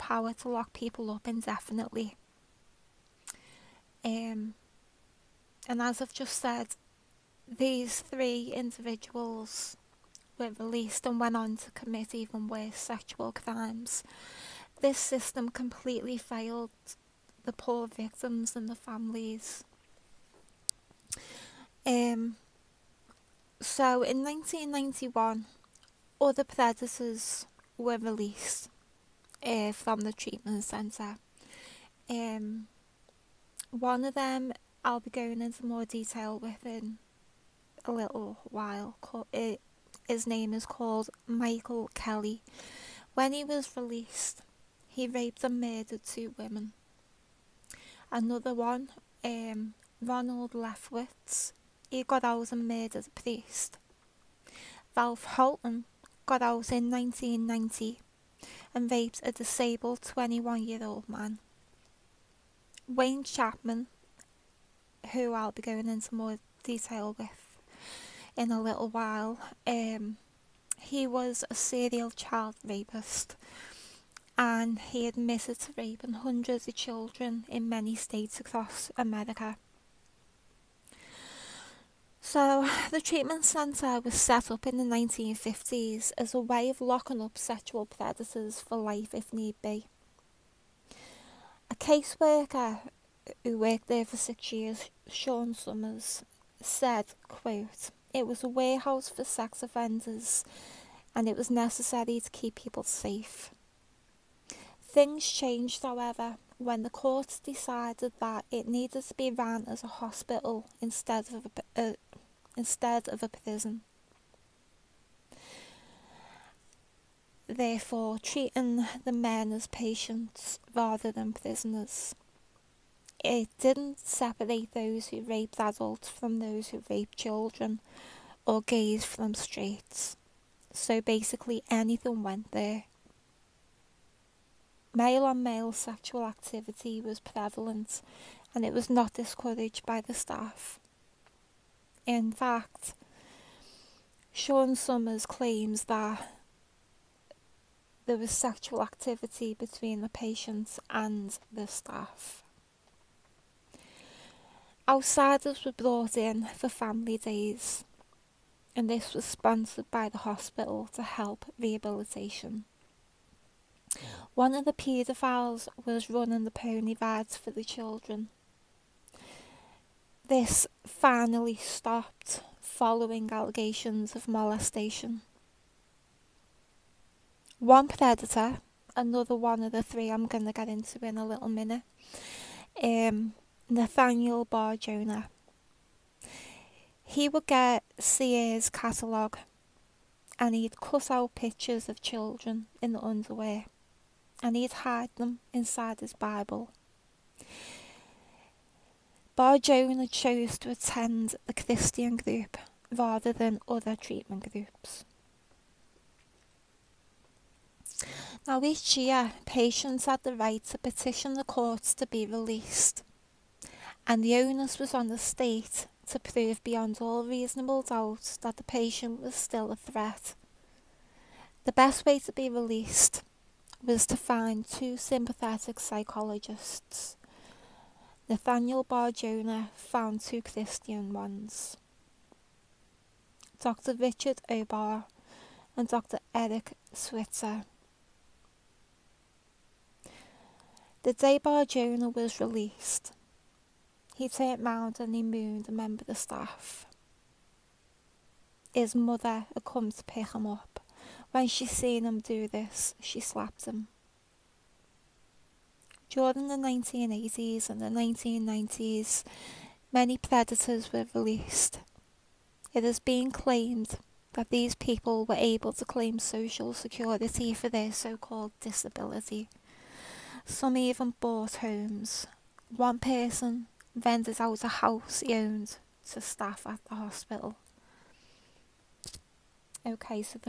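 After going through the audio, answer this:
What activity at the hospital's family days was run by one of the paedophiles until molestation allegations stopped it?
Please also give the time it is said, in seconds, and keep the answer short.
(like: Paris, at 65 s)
pony rides, at 166 s.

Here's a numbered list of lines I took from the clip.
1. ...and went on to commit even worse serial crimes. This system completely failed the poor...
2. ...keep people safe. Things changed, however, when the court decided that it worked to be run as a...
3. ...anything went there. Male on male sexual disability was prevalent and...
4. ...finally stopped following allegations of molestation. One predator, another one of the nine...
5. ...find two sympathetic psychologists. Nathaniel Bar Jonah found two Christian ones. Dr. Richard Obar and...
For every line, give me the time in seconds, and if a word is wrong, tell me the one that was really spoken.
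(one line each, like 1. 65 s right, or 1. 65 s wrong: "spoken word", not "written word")
1. 11 s wrong: "sexual", not "serial"
2. 102 s wrong: "needed", not "worked"
3. 131 s wrong: "activity", not "disability"
4. 170 s wrong: "three", not "nine"
5. 224 s right.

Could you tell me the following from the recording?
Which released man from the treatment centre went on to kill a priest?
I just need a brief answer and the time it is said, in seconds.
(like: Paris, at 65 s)
Ronald Lefwitz, at 49 s.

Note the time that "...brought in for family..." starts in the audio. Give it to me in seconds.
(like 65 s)
155 s.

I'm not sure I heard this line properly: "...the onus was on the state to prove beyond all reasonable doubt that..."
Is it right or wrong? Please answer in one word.
right.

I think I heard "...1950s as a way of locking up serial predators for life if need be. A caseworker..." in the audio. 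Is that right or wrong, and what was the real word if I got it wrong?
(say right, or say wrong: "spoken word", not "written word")
wrong: "sexual", not "serial".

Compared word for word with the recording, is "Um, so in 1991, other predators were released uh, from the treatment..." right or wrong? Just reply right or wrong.
right.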